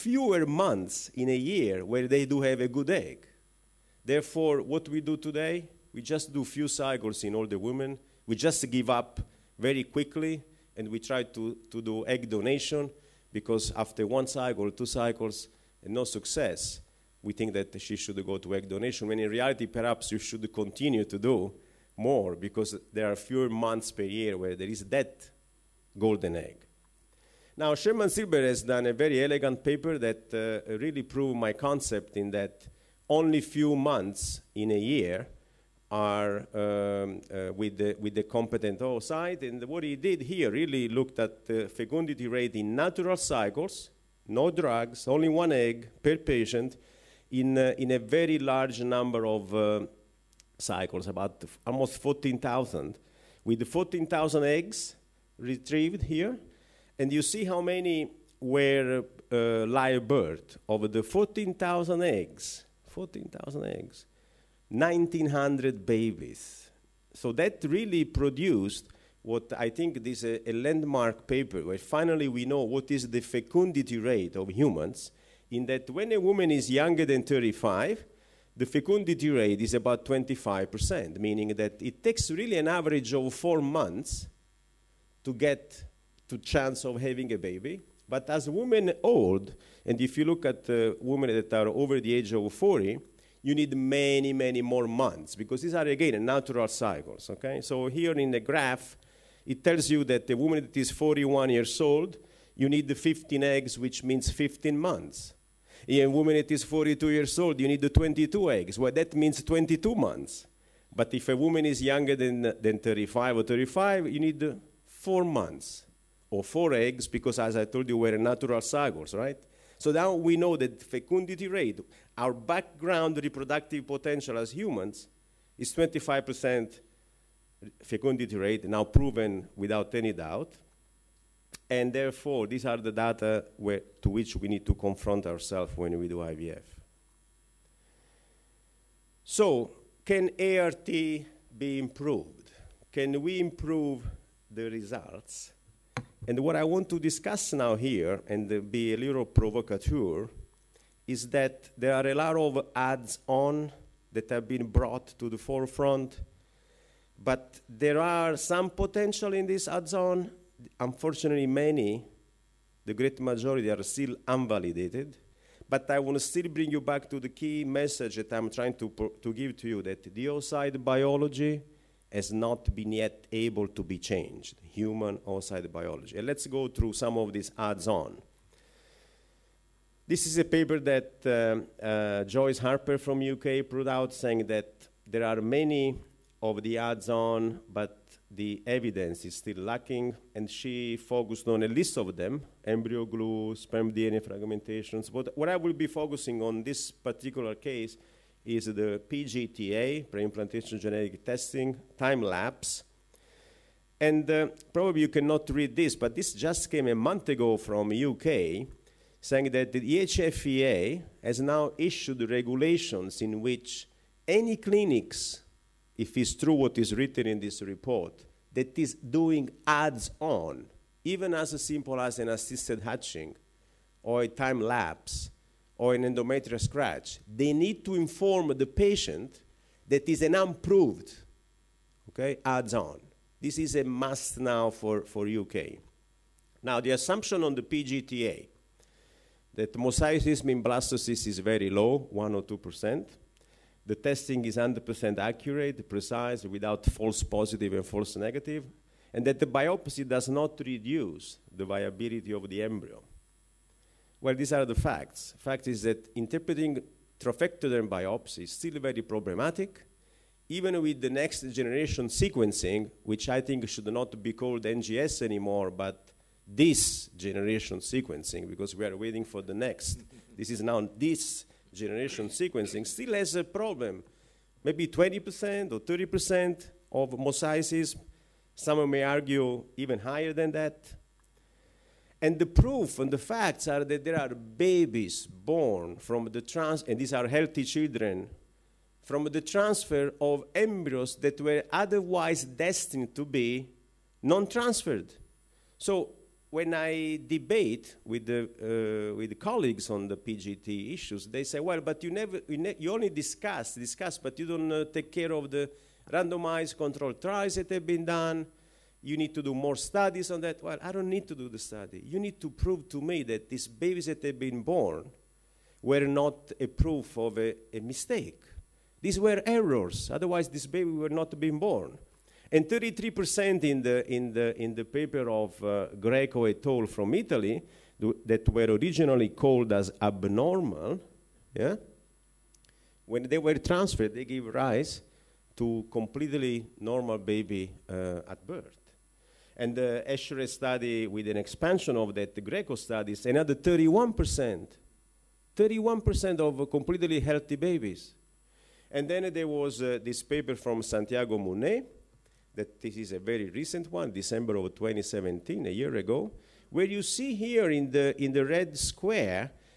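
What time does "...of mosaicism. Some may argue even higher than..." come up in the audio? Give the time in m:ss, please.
4:36.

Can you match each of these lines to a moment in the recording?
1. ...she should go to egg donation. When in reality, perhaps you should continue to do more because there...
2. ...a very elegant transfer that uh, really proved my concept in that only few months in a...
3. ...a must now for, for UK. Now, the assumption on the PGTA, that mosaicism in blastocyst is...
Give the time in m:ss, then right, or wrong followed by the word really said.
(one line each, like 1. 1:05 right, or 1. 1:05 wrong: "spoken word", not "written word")
1. 0:17 right
2. 0:28 wrong: "paper", not "transfer"
3. 3:53 right.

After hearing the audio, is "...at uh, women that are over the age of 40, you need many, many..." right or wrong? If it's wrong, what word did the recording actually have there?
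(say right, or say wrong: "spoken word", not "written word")
right.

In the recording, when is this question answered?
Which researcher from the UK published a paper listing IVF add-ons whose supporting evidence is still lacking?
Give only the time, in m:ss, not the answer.
3:02.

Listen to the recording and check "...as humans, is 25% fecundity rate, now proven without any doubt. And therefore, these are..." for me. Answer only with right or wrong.
right.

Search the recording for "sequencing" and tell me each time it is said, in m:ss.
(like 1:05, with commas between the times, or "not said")
4:22, 4:27, 4:32.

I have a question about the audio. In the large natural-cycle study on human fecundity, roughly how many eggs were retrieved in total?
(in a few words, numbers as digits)
14,000.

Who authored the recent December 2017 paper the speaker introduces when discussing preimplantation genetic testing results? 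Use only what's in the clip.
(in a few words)
Santiago Munné.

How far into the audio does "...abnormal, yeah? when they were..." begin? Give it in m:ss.
5:29.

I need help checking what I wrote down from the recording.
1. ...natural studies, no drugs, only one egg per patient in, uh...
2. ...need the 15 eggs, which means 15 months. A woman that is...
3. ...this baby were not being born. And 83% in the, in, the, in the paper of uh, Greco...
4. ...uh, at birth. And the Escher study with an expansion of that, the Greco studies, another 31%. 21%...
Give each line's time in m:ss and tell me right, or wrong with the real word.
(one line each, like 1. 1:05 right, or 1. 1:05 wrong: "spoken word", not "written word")
1. 0:42 wrong: "cycles", not "studies"
2. 1:42 right
3. 5:20 wrong: "33", not "83"
4. 5:37 wrong: "31", not "21".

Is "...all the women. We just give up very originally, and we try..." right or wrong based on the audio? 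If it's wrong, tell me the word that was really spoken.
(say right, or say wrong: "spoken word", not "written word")
wrong: "quickly", not "originally".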